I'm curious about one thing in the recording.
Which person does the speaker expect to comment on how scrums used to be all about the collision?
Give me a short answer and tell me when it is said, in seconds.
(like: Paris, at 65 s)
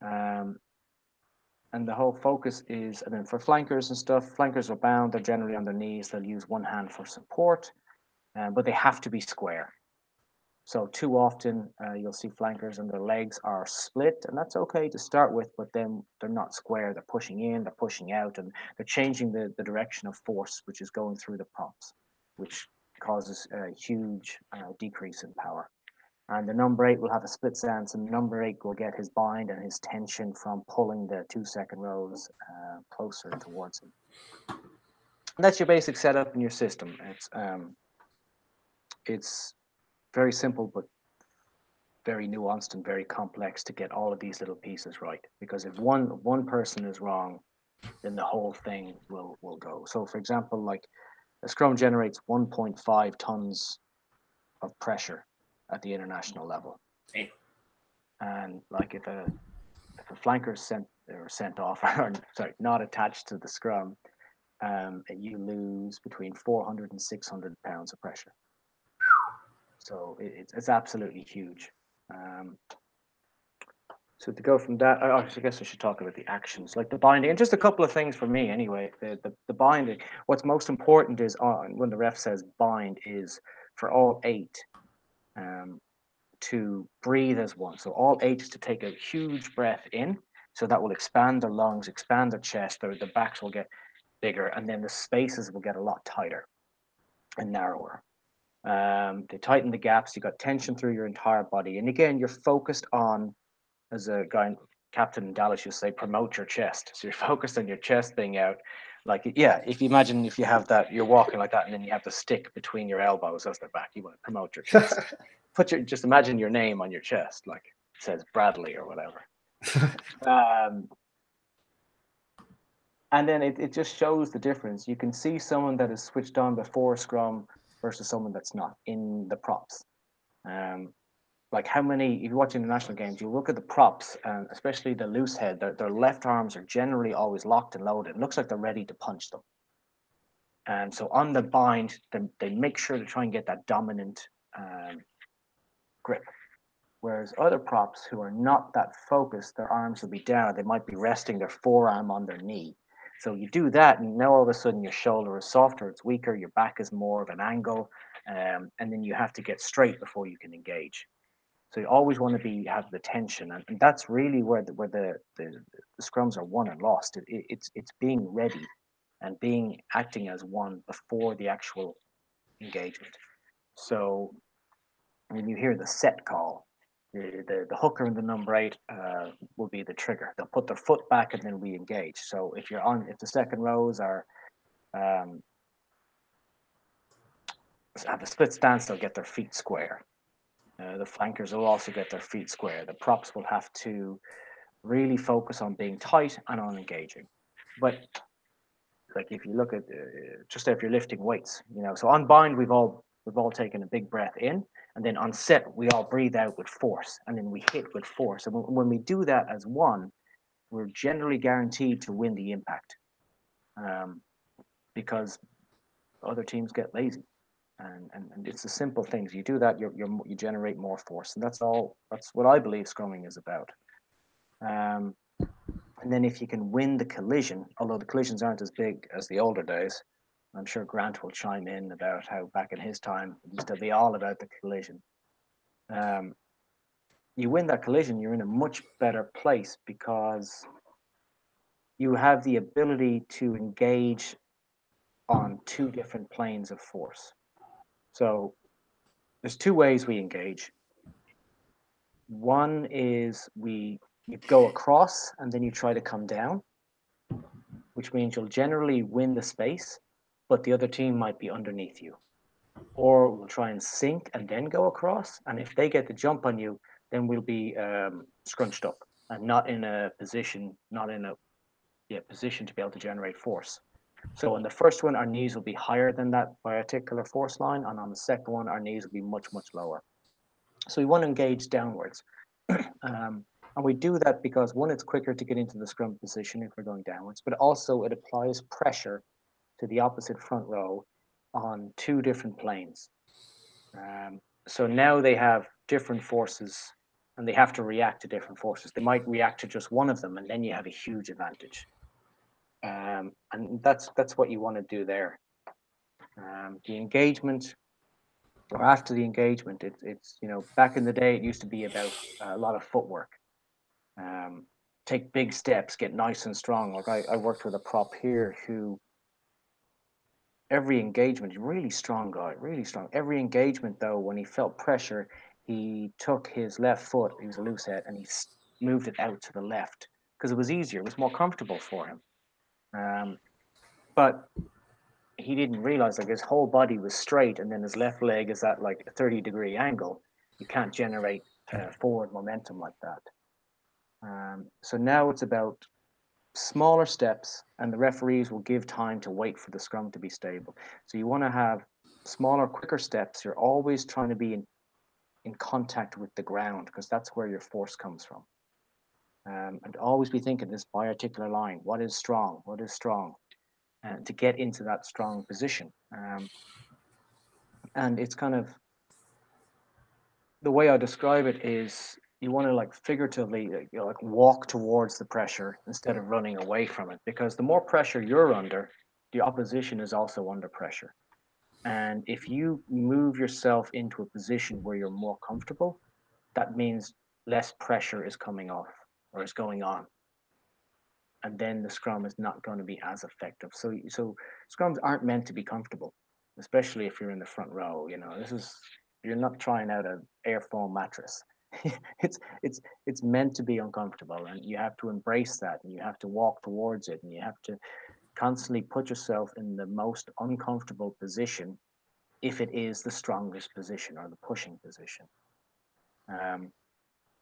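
Grant, at 230 s.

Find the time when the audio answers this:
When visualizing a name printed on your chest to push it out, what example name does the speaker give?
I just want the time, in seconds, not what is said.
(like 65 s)
118 s.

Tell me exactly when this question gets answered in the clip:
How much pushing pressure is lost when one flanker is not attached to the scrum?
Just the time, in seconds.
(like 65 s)
65 s.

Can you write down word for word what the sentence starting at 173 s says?
So when you hear the set call, the, the, the hooker and the number eight uh, will be the trigger.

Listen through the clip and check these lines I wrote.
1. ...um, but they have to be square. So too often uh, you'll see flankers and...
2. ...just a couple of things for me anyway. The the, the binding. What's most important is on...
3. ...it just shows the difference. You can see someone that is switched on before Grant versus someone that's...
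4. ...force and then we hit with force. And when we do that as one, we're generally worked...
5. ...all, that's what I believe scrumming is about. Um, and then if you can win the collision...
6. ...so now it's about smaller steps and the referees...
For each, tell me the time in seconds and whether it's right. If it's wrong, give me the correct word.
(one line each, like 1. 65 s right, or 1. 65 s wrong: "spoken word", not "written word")
1. 8 s right
2. 77 s right
3. 123 s wrong: "Scrum", not "Grant"
4. 206 s wrong: "guaranteed", not "worked"
5. 221 s right
6. 344 s right.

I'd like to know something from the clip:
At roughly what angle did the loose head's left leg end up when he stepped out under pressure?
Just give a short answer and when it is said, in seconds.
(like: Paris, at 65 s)
30 degrees, at 339 s.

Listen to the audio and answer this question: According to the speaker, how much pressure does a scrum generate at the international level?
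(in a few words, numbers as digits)
1.5 tons.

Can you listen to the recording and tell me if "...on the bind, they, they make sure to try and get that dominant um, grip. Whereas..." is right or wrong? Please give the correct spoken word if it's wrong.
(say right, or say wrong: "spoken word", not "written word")
right.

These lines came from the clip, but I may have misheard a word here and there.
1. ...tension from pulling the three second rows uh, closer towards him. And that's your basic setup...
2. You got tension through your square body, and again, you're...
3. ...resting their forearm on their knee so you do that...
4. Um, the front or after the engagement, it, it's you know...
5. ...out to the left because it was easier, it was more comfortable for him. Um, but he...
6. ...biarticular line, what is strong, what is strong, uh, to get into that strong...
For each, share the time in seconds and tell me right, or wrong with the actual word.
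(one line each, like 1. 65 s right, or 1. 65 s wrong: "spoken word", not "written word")
1. 29 s wrong: "two", not "three"
2. 100 s wrong: "entire", not "square"
3. 150 s right
4. 306 s wrong: "engagement", not "front"
5. 329 s right
6. 360 s right.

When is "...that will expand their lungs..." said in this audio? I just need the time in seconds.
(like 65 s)
90 s.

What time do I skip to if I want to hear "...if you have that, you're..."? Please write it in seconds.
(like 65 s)
110 s.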